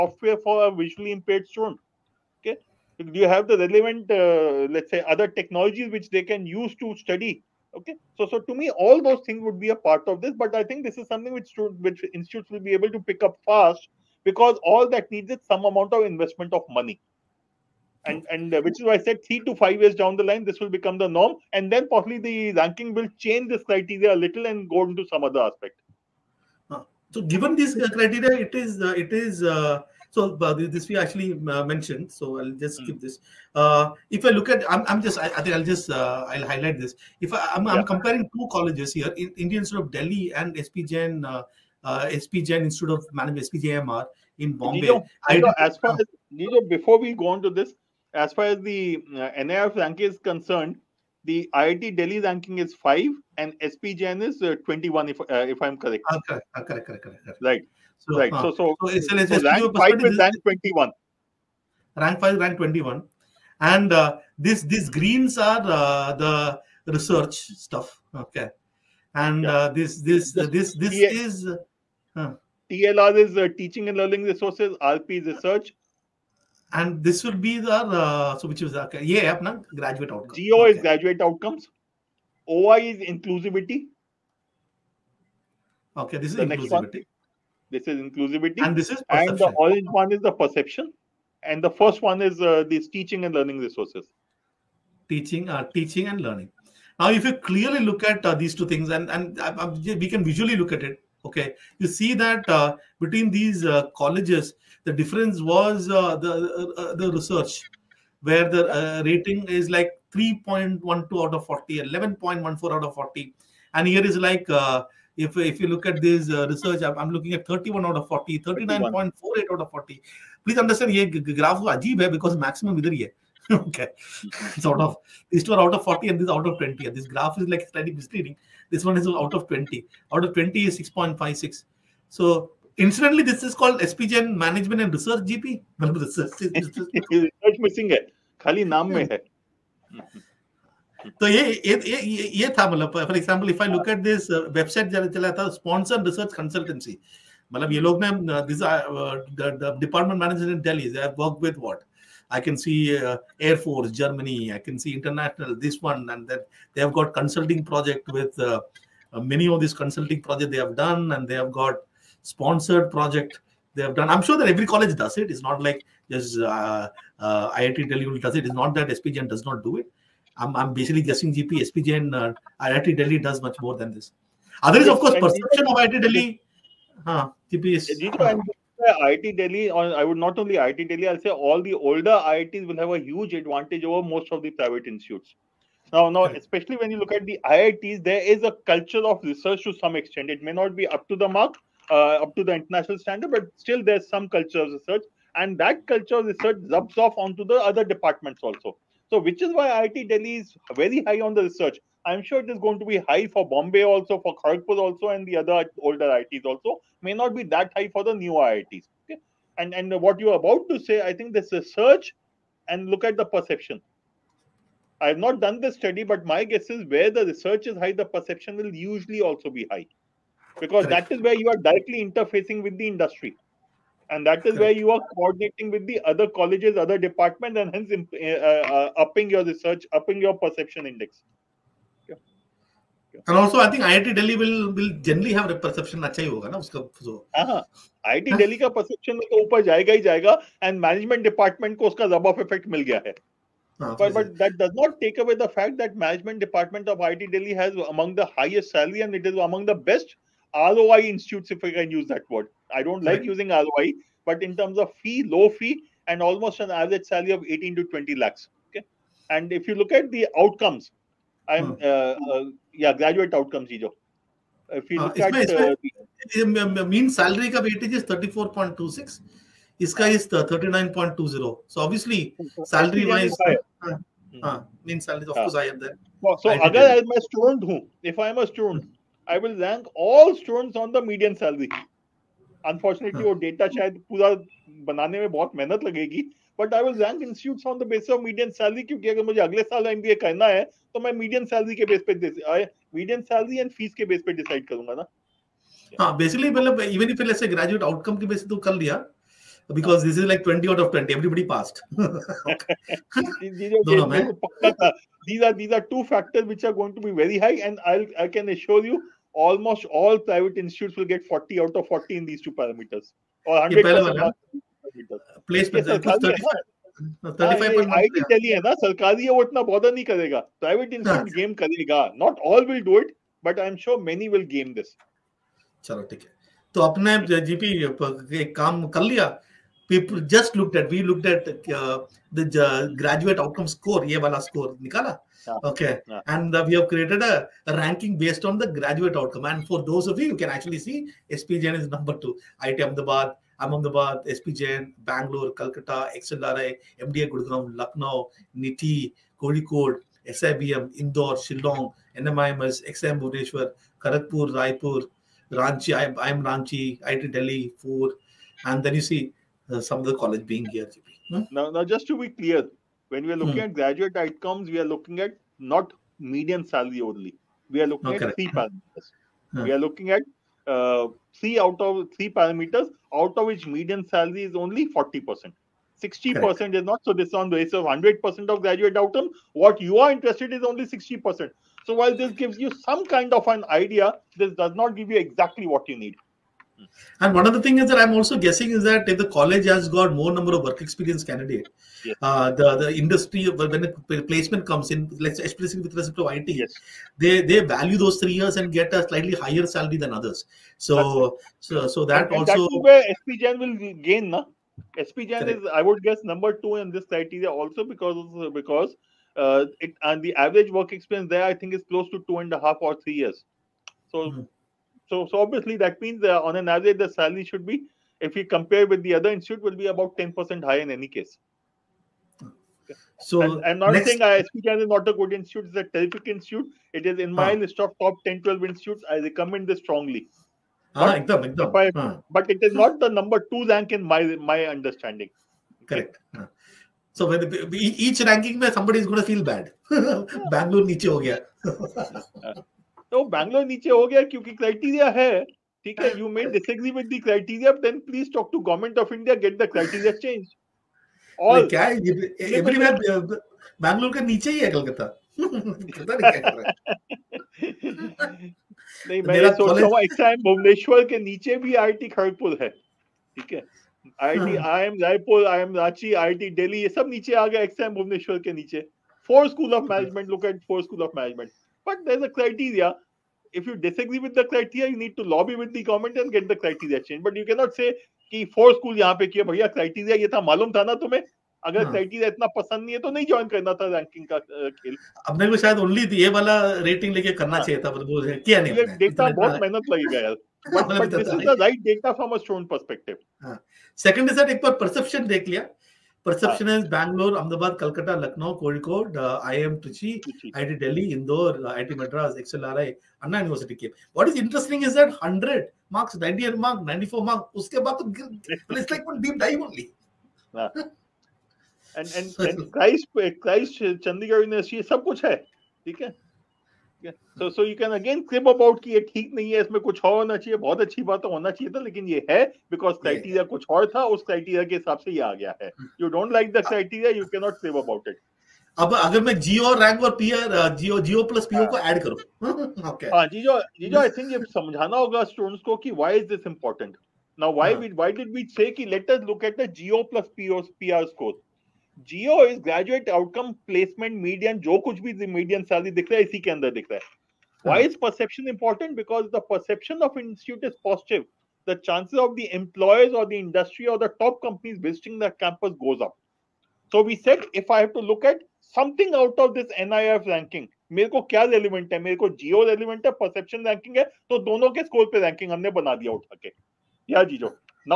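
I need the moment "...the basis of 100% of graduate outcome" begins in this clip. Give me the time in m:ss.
6:17.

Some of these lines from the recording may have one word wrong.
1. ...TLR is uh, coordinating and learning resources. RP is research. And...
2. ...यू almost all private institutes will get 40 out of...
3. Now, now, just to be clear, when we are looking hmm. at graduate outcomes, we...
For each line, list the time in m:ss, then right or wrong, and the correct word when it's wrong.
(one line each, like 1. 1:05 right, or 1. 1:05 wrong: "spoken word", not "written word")
1. 1:12 wrong: "teaching", not "coordinating"
2. 5:08 right
3. 6:01 right.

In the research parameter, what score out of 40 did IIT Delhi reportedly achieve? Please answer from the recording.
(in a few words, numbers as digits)
39.48.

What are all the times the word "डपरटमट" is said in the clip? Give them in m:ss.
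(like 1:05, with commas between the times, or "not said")
2:29, 4:01.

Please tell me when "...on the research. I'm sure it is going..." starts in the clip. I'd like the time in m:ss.
3:21.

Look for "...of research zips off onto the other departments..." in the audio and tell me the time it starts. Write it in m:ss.
3:16.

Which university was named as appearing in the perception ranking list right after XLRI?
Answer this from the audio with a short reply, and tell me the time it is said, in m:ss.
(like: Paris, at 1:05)
Anna University, at 8:23.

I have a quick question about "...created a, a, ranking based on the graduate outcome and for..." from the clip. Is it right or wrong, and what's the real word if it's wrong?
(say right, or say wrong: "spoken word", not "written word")
right.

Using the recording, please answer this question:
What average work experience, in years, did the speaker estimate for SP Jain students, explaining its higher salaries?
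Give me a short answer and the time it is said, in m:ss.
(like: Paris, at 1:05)
two and a half or three years, at 6:52.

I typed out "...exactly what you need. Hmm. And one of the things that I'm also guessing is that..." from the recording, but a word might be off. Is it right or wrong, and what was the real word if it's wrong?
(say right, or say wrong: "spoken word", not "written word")
right.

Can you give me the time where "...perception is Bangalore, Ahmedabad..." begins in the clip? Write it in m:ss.
8:16.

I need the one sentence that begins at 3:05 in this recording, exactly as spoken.
Now, now, especially when you look at the IITs, there is a culture of research to some extent.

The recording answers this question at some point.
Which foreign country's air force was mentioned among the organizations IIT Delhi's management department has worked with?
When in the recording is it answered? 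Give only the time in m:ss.
2:33.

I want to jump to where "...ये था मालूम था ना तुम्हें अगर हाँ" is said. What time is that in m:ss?
8:00.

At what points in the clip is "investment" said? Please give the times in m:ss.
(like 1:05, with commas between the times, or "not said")
0:16.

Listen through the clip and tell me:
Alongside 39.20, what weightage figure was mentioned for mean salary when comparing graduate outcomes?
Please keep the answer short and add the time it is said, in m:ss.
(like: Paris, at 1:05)
34.26, at 4:28.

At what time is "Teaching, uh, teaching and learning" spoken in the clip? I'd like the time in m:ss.
1:35.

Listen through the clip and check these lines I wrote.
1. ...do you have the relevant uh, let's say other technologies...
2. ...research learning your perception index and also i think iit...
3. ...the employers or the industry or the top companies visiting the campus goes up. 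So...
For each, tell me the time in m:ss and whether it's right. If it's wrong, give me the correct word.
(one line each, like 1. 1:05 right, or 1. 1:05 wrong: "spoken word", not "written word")
1. 0:03 right
2. 3:49 wrong: "upping", not "learning"
3. 9:12 right.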